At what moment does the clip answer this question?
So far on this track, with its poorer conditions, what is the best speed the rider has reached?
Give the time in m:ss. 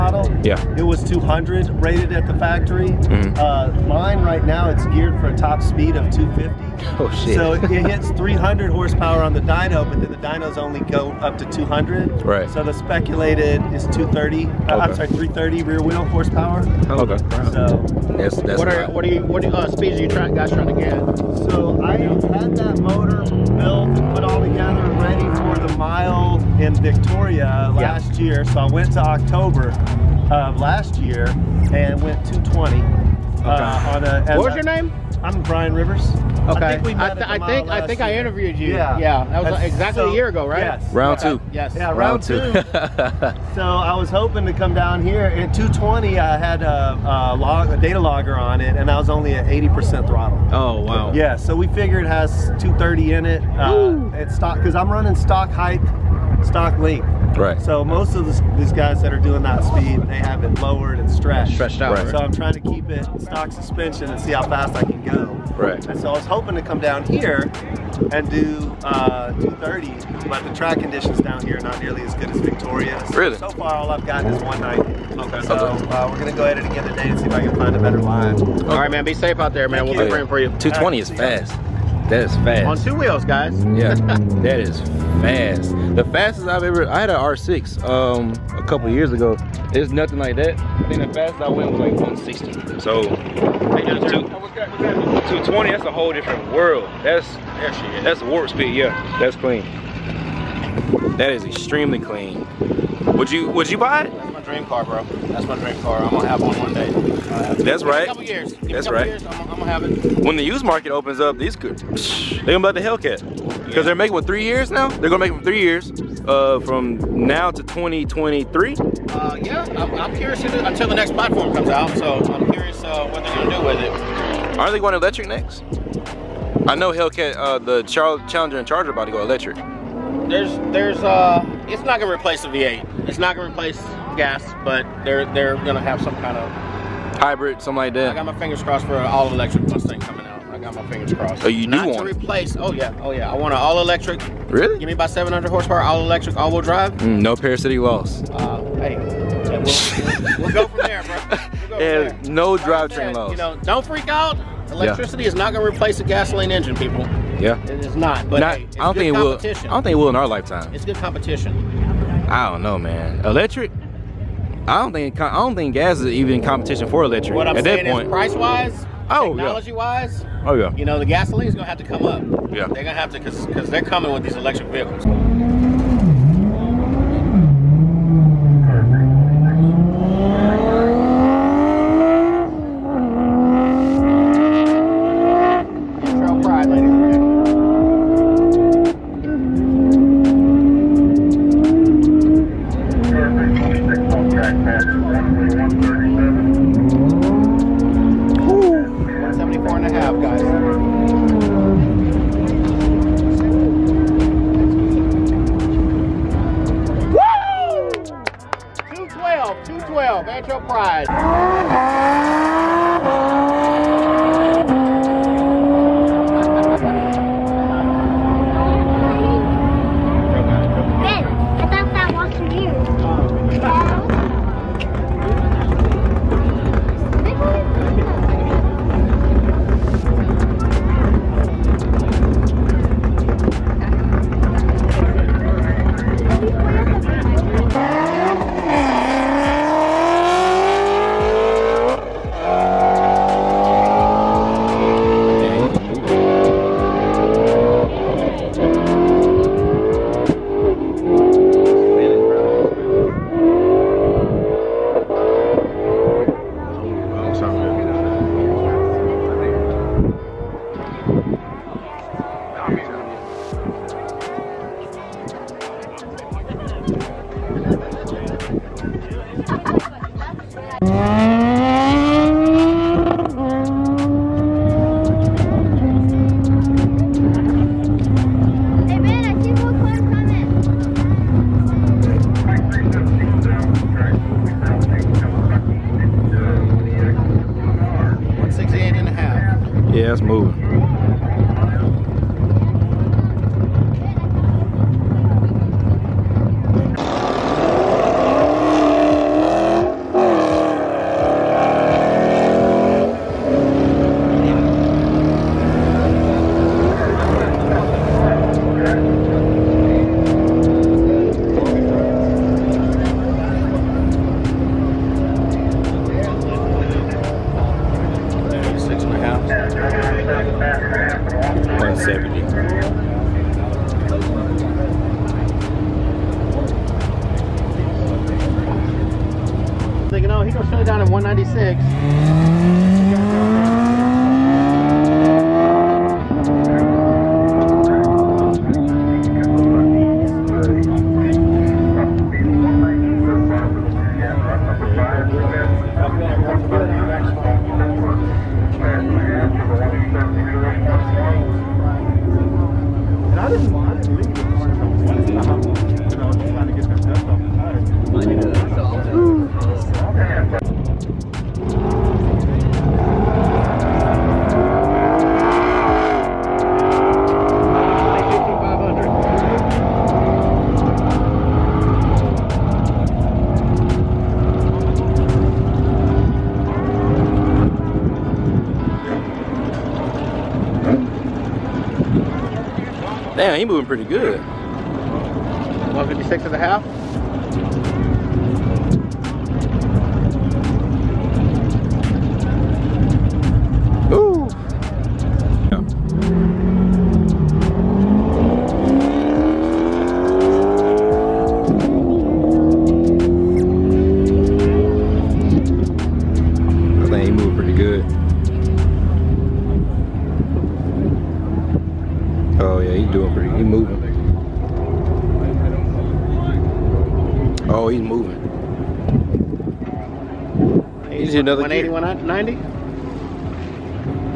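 1:14.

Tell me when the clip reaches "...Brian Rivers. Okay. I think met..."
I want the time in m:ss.
0:35.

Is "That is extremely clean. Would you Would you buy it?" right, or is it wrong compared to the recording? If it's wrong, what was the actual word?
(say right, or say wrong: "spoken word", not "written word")
right.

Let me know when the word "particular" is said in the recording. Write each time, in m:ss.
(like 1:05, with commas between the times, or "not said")
not said.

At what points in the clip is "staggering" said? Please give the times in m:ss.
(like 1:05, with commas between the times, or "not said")
not said.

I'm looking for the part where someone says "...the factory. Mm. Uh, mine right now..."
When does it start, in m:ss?
0:02.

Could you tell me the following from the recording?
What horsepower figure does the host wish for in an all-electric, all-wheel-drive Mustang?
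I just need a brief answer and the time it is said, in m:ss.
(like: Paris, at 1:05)
700, at 2:25.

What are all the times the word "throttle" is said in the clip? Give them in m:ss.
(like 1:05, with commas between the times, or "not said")
0:50.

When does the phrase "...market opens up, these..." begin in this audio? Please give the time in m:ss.
1:50.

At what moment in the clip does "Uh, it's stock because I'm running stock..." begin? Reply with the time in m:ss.
0:53.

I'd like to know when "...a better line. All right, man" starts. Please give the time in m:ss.
1:17.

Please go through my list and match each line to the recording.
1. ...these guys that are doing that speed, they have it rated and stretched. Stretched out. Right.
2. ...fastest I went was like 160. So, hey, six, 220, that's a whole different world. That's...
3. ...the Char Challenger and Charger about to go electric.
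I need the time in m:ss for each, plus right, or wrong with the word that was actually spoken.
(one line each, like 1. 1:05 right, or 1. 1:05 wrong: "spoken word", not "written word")
1. 0:58 wrong: "lowered", not "rated"
2. 1:31 wrong: "two", not "six"
3. 2:07 right.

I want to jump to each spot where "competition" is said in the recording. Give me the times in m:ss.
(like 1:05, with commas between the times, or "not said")
2:40, 2:46.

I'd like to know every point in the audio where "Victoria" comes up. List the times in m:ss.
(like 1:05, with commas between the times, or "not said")
0:26, 1:12.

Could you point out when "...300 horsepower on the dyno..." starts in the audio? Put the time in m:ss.
0:08.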